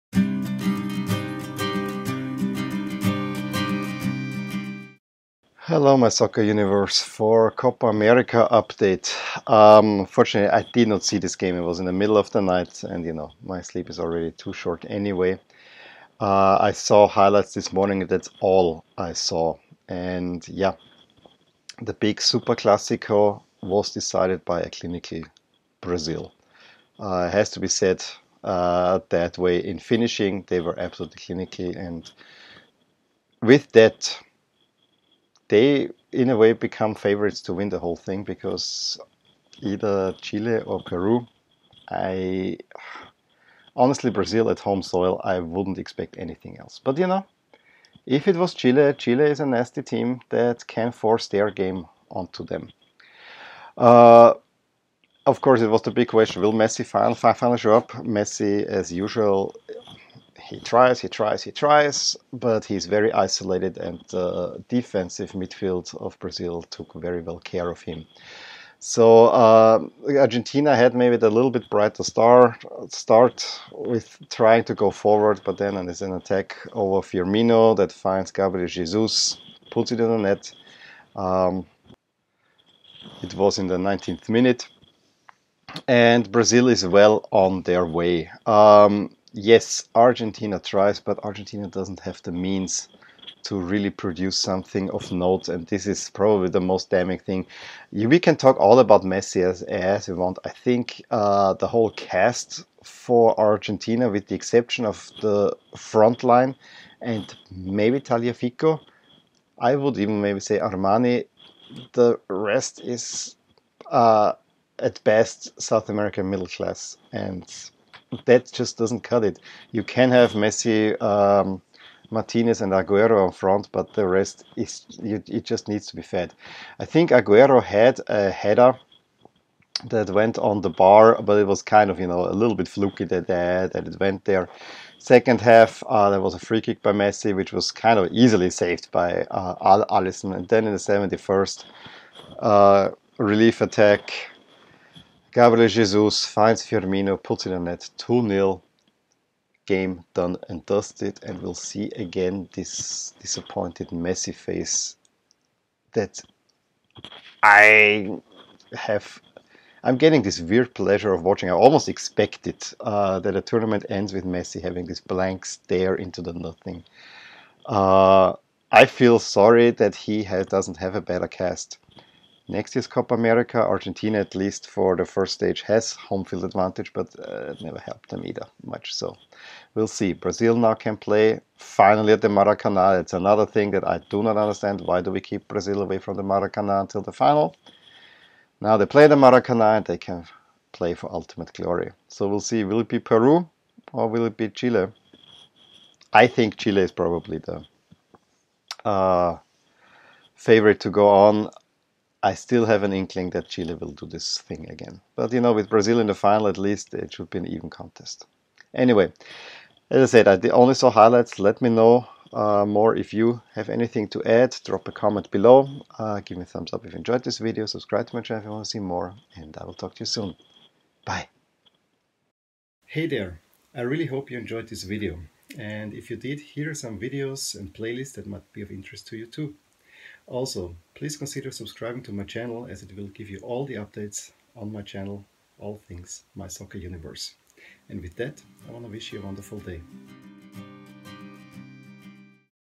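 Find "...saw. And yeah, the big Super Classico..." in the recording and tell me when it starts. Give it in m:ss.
0:19.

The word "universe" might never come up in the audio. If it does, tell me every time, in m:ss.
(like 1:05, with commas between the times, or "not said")
0:06, 3:56.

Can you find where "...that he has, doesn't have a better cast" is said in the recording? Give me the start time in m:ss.
2:49.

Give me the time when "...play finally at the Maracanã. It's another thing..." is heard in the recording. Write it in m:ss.
3:00.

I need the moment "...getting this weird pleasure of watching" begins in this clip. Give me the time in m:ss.
2:39.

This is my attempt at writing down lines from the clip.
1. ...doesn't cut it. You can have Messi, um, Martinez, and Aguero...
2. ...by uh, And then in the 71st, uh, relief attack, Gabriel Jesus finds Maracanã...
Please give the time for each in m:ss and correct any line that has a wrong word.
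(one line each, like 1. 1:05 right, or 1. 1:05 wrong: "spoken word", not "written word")
1. 1:58 right
2. 2:18 wrong: "Firmino", not "Maracanã".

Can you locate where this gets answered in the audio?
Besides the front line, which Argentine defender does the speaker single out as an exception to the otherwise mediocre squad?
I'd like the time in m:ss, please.
1:47.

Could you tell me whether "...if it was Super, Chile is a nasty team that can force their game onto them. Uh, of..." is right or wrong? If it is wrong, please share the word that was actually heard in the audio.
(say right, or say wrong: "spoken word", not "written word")
wrong: "Chile", not "Super".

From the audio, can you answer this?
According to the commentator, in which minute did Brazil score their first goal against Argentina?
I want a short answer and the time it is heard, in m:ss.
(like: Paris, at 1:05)
19th minute, at 1:23.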